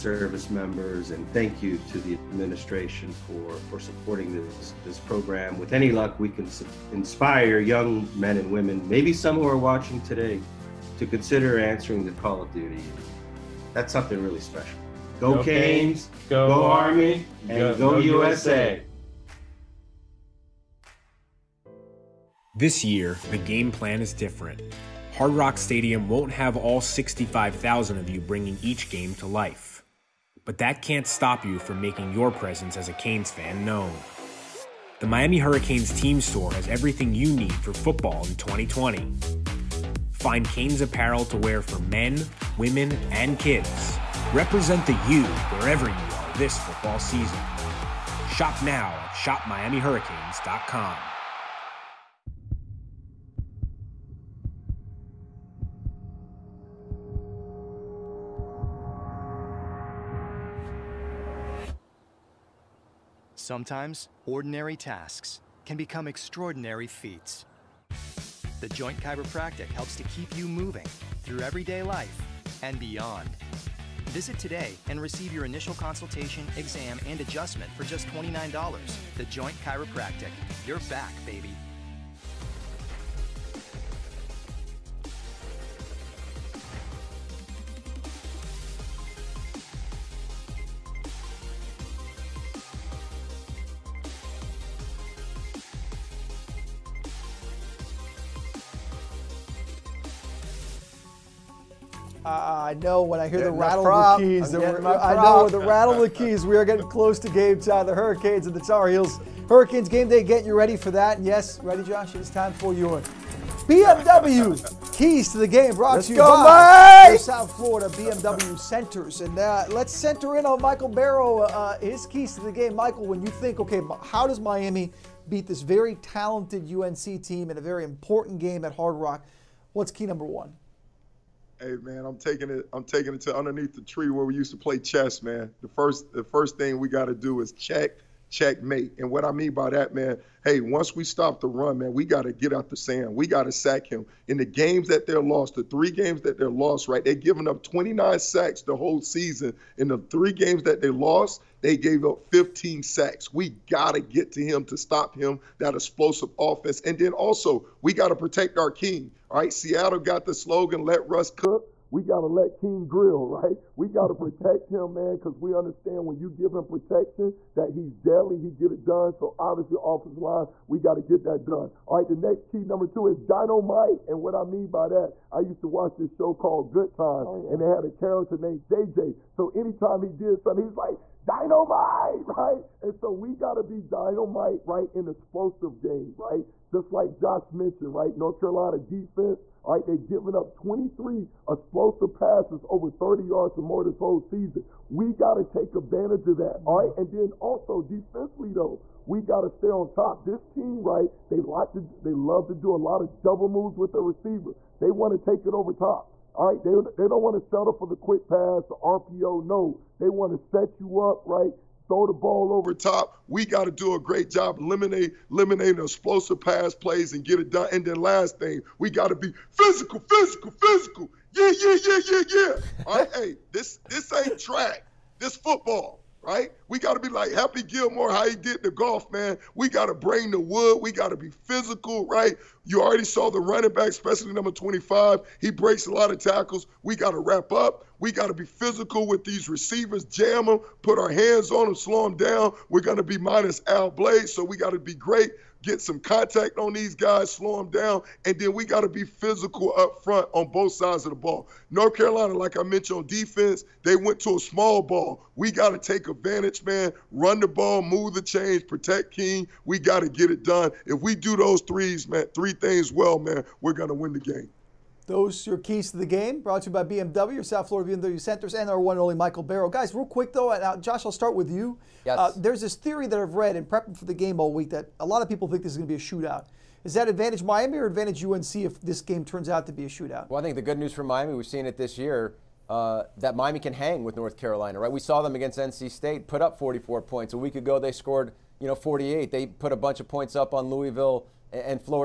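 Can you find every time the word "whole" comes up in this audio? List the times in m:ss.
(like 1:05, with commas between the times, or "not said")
2:28, 3:13.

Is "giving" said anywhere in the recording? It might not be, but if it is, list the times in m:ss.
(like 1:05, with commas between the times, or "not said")
2:27, 3:09.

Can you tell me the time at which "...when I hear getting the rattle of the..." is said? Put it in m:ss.
1:43.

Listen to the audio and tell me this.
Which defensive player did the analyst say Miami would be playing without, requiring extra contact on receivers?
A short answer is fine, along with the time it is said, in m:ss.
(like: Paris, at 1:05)
Al Blades, at 4:03.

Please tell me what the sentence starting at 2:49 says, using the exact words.
So obviously, offensive line, we got to get that done.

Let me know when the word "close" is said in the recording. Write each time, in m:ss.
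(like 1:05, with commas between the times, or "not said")
1:46.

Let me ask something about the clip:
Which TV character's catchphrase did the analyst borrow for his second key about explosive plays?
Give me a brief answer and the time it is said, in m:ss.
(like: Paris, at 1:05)
JJ, at 2:58.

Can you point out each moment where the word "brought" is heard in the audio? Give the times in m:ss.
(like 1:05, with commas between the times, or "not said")
1:55, 4:26.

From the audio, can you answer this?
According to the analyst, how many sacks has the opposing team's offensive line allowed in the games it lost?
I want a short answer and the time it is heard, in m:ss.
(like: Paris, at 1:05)
15, at 2:32.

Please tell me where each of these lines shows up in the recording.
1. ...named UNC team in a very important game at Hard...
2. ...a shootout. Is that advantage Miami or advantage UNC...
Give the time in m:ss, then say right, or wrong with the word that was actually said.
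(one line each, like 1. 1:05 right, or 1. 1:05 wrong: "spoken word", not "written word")
1. 2:05 wrong: "talented", not "named"
2. 4:35 right.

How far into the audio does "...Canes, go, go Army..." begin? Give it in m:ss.
0:15.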